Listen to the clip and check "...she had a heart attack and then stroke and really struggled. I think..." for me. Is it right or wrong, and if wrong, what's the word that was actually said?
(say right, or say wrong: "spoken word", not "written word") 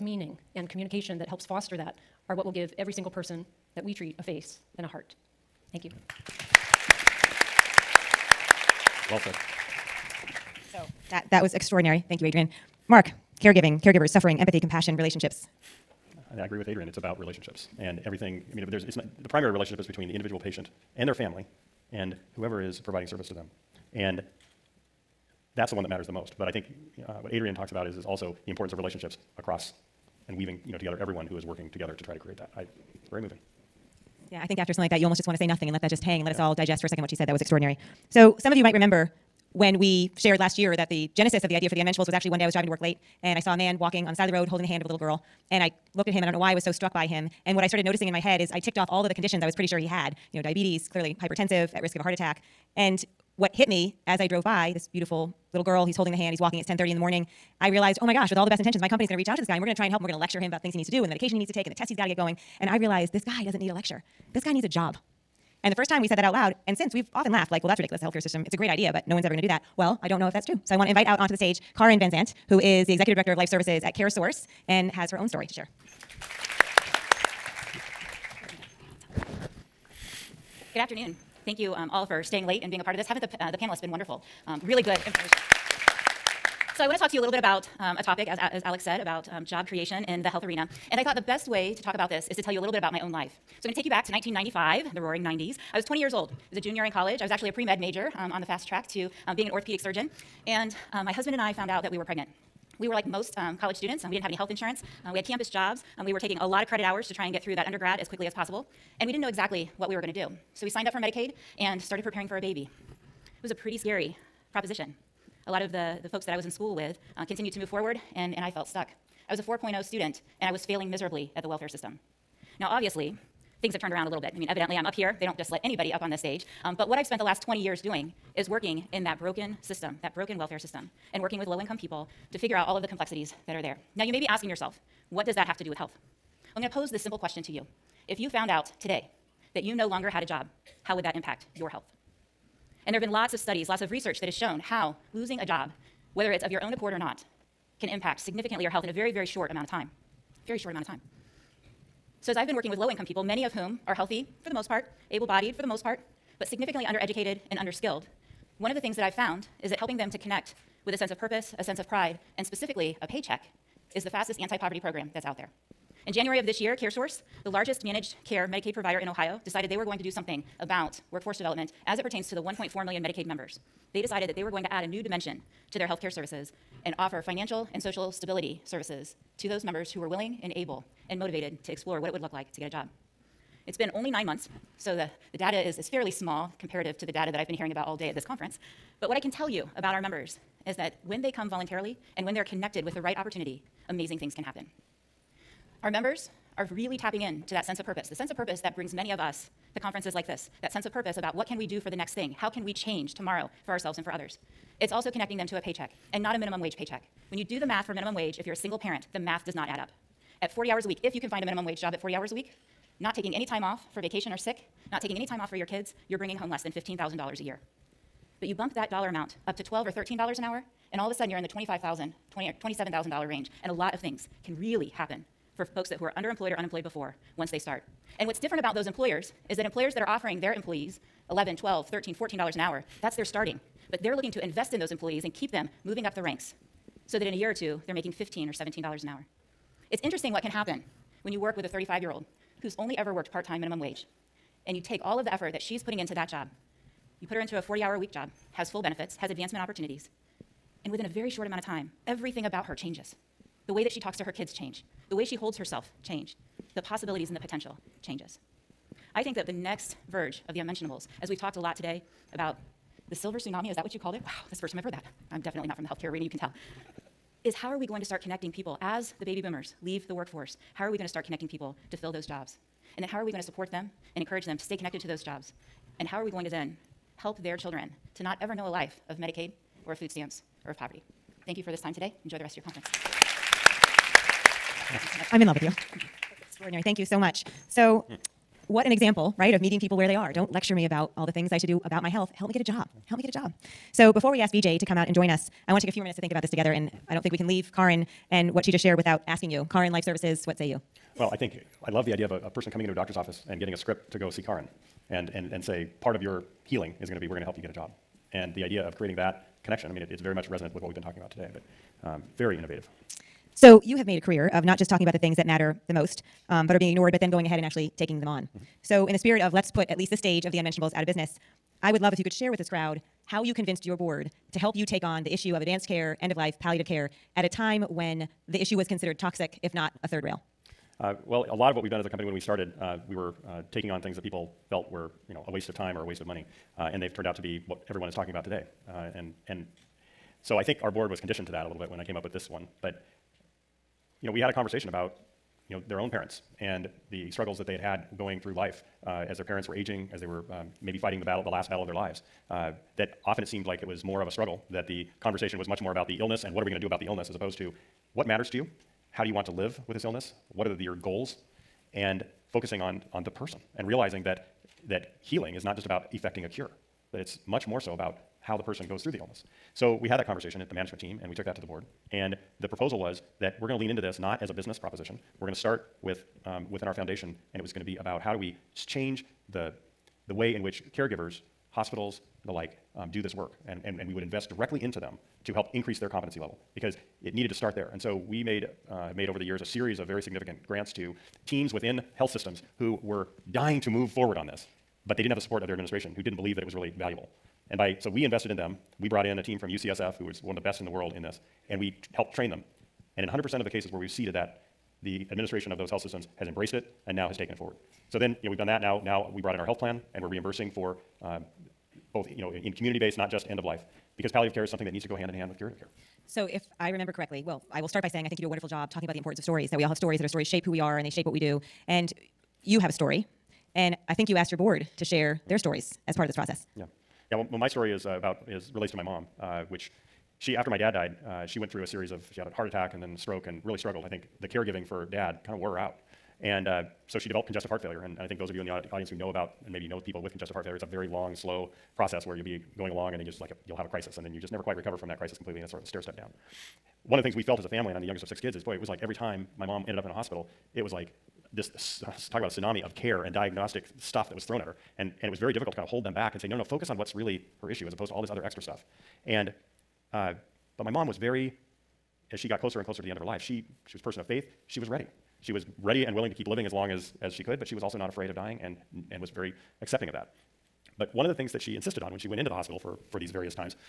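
right.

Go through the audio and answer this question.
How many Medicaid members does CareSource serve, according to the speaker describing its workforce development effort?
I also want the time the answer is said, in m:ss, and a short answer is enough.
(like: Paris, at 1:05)
1.4 million, at 2:52.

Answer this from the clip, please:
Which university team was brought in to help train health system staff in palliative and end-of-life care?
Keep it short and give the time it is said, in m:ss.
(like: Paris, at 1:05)
UCSF, at 6:39.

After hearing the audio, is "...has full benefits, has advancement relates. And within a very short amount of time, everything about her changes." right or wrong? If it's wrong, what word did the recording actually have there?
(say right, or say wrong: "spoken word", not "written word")
wrong: "opportunities", not "relates".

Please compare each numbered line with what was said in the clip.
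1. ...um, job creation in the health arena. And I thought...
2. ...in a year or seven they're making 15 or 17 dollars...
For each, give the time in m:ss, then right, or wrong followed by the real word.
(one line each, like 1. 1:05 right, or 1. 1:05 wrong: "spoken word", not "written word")
1. 1:29 right
2. 3:57 wrong: "two", not "seven".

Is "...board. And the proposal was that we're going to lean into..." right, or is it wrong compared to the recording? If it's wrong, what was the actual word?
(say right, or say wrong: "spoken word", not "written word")
right.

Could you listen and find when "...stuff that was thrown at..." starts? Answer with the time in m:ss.
7:33.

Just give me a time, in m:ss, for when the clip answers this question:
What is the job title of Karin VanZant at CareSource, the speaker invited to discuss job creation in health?
1:12.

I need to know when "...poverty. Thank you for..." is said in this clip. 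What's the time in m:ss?
4:40.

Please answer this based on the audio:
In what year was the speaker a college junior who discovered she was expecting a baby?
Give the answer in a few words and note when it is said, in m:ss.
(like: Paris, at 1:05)
1995, at 1:34.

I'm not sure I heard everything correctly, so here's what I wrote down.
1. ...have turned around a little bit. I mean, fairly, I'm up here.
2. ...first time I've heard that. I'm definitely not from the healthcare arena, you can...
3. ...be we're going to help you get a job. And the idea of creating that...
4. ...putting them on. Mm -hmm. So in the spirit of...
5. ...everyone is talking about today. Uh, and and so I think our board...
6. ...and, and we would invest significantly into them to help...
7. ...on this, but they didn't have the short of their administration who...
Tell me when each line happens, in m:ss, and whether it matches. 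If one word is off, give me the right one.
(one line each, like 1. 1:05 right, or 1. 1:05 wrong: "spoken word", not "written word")
1. 2:03 wrong: "evidently", not "fairly"
2. 4:24 right
3. 5:07 right
4. 5:17 wrong: "taking", not "putting"
5. 5:37 right
6. 6:23 wrong: "directly", not "significantly"
7. 6:34 wrong: "support", not "short".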